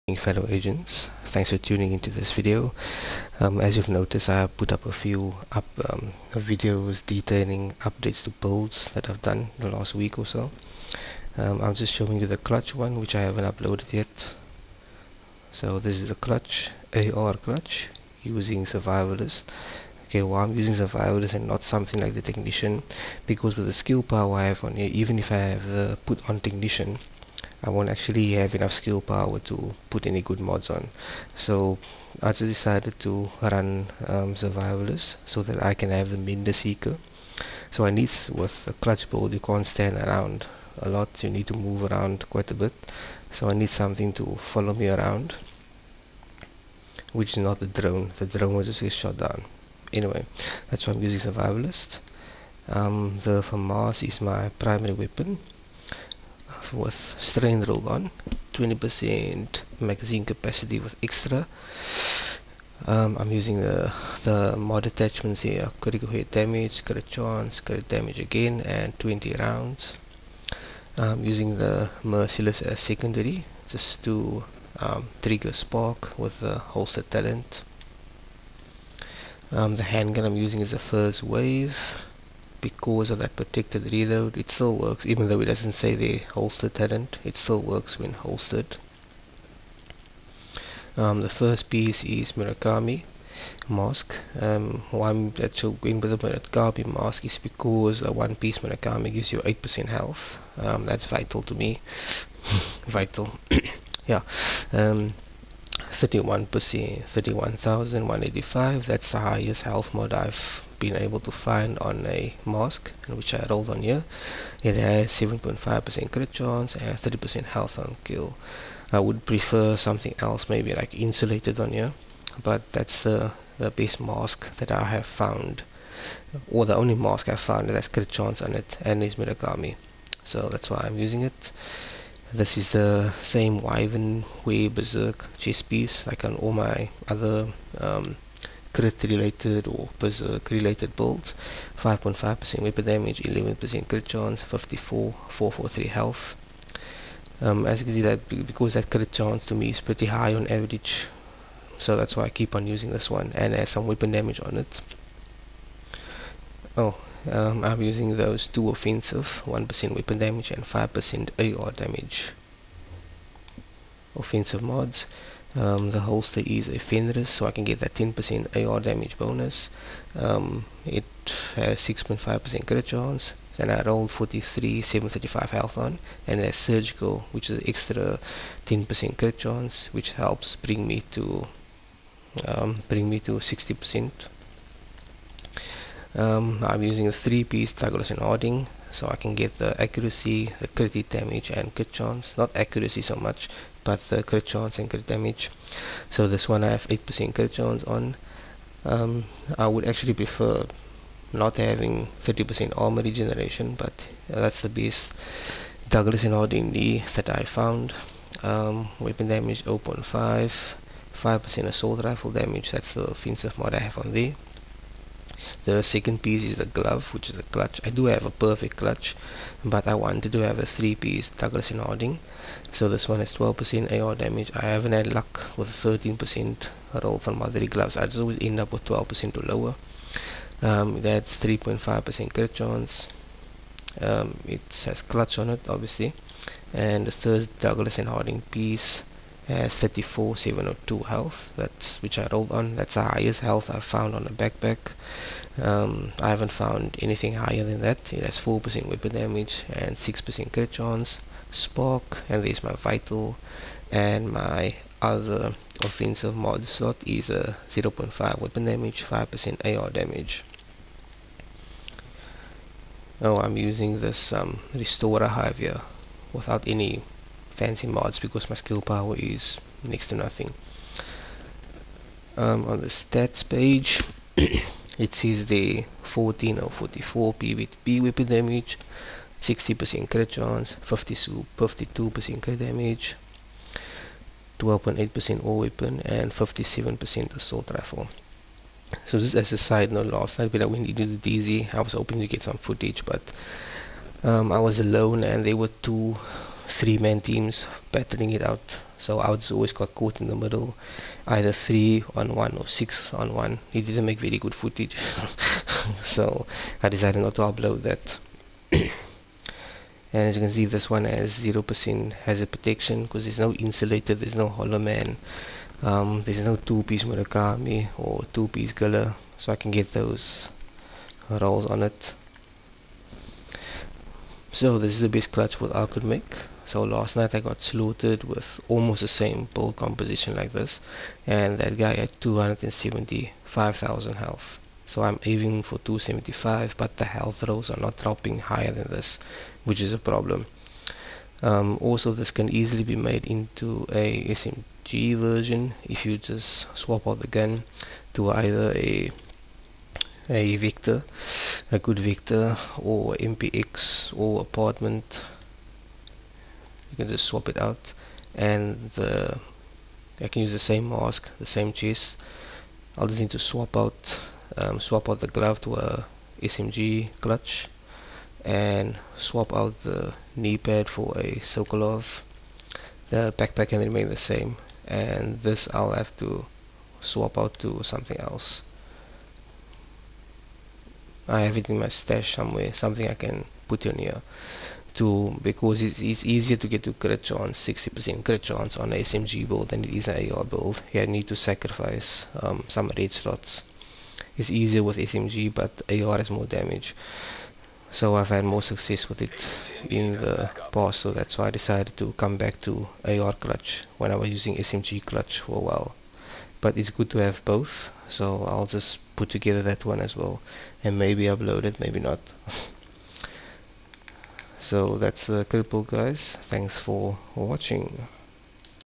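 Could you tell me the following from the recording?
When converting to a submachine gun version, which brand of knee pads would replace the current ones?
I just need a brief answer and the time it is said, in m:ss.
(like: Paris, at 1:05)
Sokolov, at 6:11.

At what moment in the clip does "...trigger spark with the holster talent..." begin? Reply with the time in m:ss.
1:15.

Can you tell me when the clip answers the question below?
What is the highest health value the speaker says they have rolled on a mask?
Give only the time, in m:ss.
1:47.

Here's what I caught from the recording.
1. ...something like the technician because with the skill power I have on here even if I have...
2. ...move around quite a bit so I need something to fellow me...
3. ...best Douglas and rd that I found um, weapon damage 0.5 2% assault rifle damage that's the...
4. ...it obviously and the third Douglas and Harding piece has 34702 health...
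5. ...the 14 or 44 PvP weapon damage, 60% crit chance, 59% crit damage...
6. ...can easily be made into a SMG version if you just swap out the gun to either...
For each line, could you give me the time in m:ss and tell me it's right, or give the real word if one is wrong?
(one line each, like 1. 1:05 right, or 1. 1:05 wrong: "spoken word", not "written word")
1. 0:21 right
2. 0:41 wrong: "follow", not "fellow"
3. 3:24 wrong: "5", not "2"
4. 3:55 right
5. 4:35 wrong: "52", not "59"
6. 5:42 right.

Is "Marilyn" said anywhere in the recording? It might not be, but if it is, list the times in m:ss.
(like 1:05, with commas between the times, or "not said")
not said.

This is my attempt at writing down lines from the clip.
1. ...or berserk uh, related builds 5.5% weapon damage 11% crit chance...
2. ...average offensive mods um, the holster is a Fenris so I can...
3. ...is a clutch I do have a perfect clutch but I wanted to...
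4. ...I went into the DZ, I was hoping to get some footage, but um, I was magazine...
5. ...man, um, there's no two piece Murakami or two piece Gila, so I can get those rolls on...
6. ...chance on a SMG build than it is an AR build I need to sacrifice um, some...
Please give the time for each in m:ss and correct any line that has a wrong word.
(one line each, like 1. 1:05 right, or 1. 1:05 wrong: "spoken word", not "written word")
1. 2:19 right
2. 2:41 wrong: "damage", not "average"
3. 3:37 right
4. 4:50 wrong: "alone", not "magazine"
5. 5:14 right
6. 6:28 right.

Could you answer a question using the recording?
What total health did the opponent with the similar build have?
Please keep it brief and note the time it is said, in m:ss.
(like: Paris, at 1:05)
275,000, at 5:32.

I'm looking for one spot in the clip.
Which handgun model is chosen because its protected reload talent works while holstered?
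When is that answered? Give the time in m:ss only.
1:20.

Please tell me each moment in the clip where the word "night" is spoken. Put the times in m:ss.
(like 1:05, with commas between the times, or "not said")
4:50, 5:27.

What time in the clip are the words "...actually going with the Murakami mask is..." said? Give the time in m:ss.
1:35.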